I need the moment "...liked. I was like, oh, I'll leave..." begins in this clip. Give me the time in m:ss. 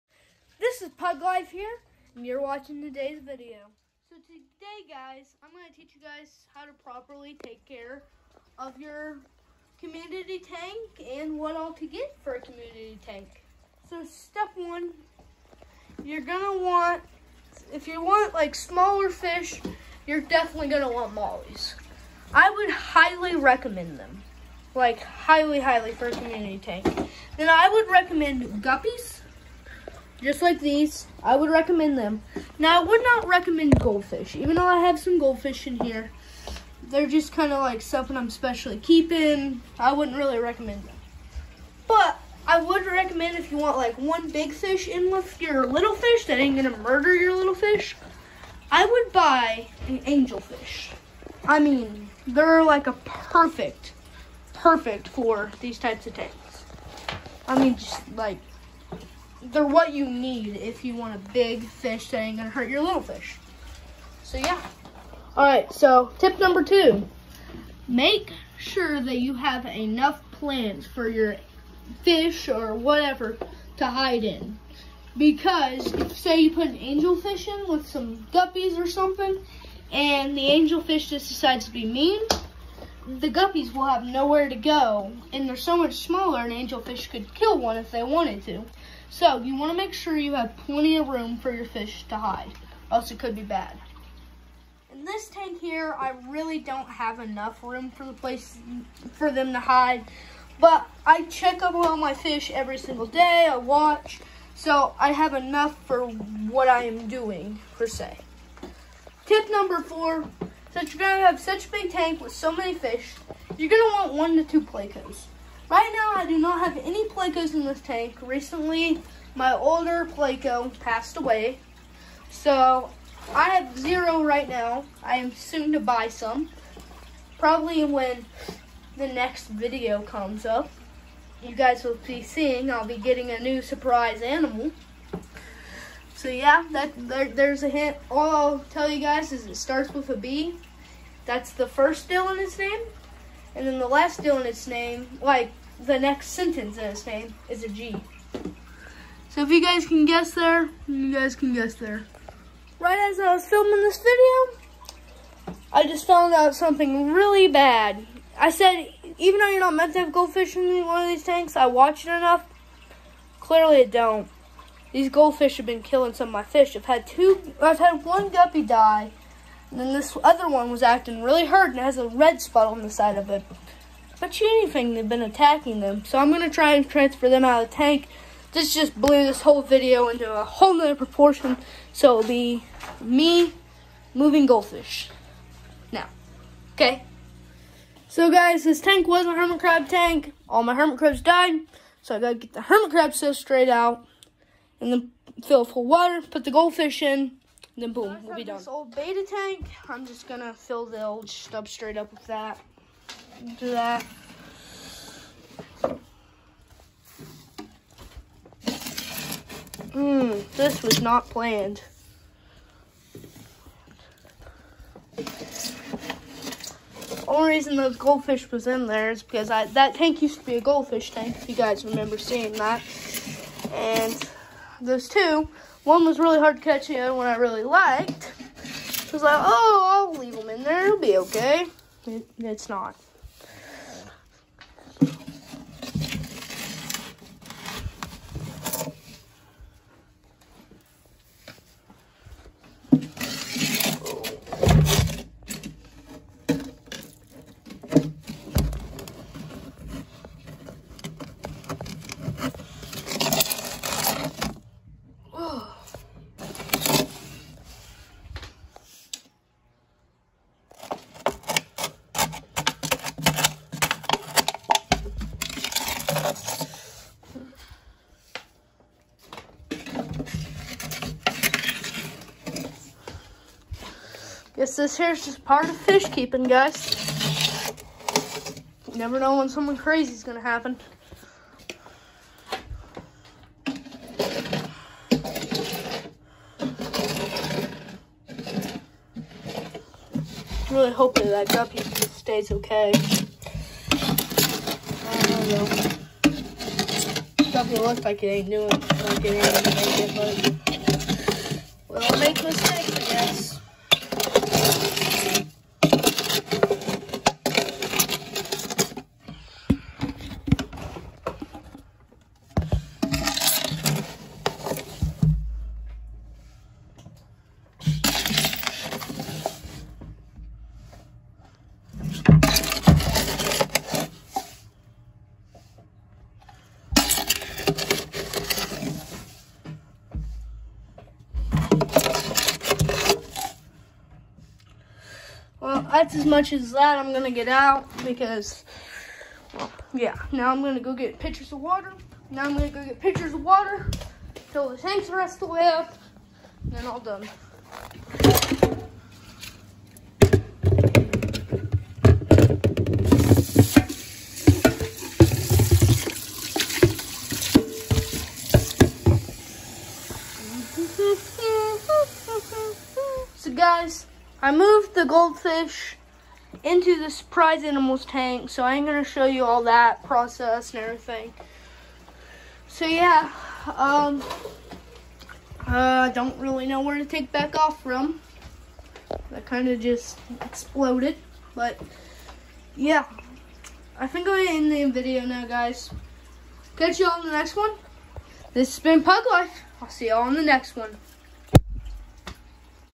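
3:47.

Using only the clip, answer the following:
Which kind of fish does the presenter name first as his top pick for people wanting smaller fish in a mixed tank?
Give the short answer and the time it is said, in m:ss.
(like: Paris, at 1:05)
Mollies, at 0:21.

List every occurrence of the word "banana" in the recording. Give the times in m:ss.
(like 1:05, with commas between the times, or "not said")
not said.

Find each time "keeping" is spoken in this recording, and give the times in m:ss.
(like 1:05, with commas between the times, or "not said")
0:38, 4:36.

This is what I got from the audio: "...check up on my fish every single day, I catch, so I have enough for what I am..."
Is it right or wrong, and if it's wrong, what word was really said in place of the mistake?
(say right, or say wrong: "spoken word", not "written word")
wrong: "watch", not "catch".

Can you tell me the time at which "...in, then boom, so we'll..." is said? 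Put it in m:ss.
3:17.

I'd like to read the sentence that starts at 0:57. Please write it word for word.
I mean, just like they're what you need if you want a big fish that ain't gonna hurt your little fish.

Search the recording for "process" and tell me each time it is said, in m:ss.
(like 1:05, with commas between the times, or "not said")
6:10.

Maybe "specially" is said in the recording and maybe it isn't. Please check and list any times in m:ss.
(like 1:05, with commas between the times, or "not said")
0:38.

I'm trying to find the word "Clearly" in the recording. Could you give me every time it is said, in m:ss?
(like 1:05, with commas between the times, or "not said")
2:43.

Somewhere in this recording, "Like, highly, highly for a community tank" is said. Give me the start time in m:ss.
0:24.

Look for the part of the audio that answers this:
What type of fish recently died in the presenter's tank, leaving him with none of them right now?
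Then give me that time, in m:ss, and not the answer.
2:00.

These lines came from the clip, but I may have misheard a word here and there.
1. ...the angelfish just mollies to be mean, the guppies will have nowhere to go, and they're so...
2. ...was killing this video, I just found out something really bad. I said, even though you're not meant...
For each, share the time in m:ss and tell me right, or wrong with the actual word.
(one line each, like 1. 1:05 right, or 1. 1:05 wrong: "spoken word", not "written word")
1. 1:20 wrong: "decides", not "mollies"
2. 2:33 wrong: "filming", not "killing".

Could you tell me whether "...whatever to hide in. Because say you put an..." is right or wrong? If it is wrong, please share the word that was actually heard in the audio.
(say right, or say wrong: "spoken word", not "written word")
right.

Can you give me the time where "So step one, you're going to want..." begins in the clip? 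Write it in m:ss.
0:13.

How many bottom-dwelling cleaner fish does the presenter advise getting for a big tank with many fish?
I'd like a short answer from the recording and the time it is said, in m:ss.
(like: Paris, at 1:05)
1 to 2, at 1:54.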